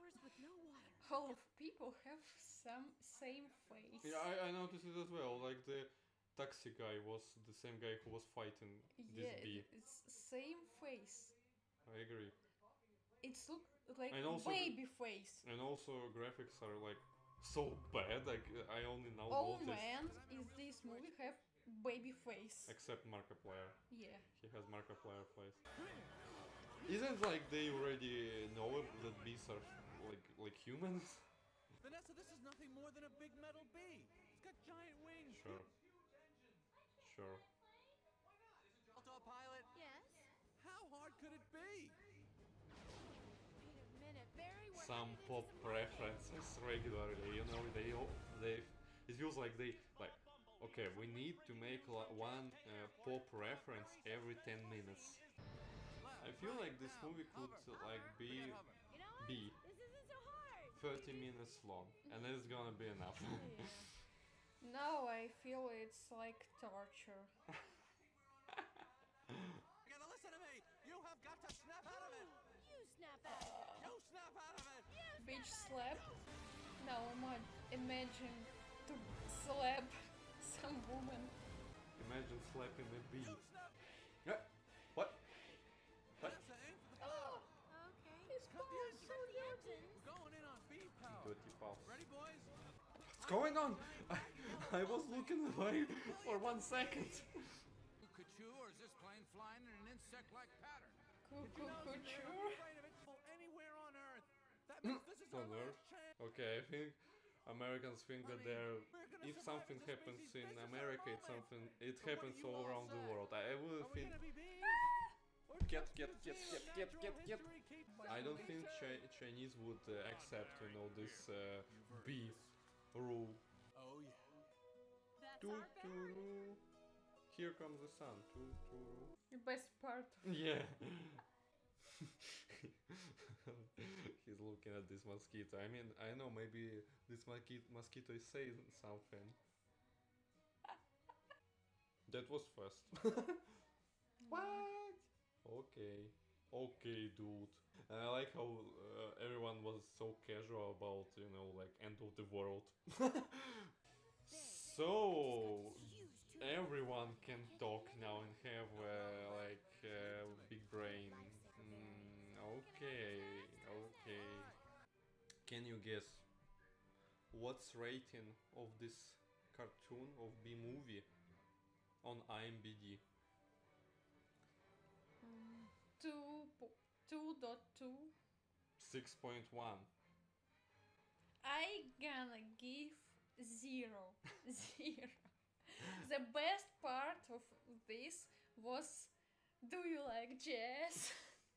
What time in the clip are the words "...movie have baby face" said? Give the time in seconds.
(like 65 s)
20 s.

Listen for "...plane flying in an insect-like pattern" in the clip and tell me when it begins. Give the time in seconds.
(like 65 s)
98 s.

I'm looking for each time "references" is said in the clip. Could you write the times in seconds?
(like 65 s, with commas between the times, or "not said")
45 s, 53 s.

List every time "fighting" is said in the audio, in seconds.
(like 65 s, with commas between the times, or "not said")
8 s.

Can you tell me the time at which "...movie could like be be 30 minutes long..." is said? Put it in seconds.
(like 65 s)
57 s.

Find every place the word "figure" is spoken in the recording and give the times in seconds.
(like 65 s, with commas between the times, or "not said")
not said.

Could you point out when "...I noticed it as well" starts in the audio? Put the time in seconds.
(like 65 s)
4 s.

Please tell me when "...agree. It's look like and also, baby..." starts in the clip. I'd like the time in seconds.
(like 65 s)
11 s.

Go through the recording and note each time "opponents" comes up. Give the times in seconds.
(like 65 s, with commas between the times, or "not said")
not said.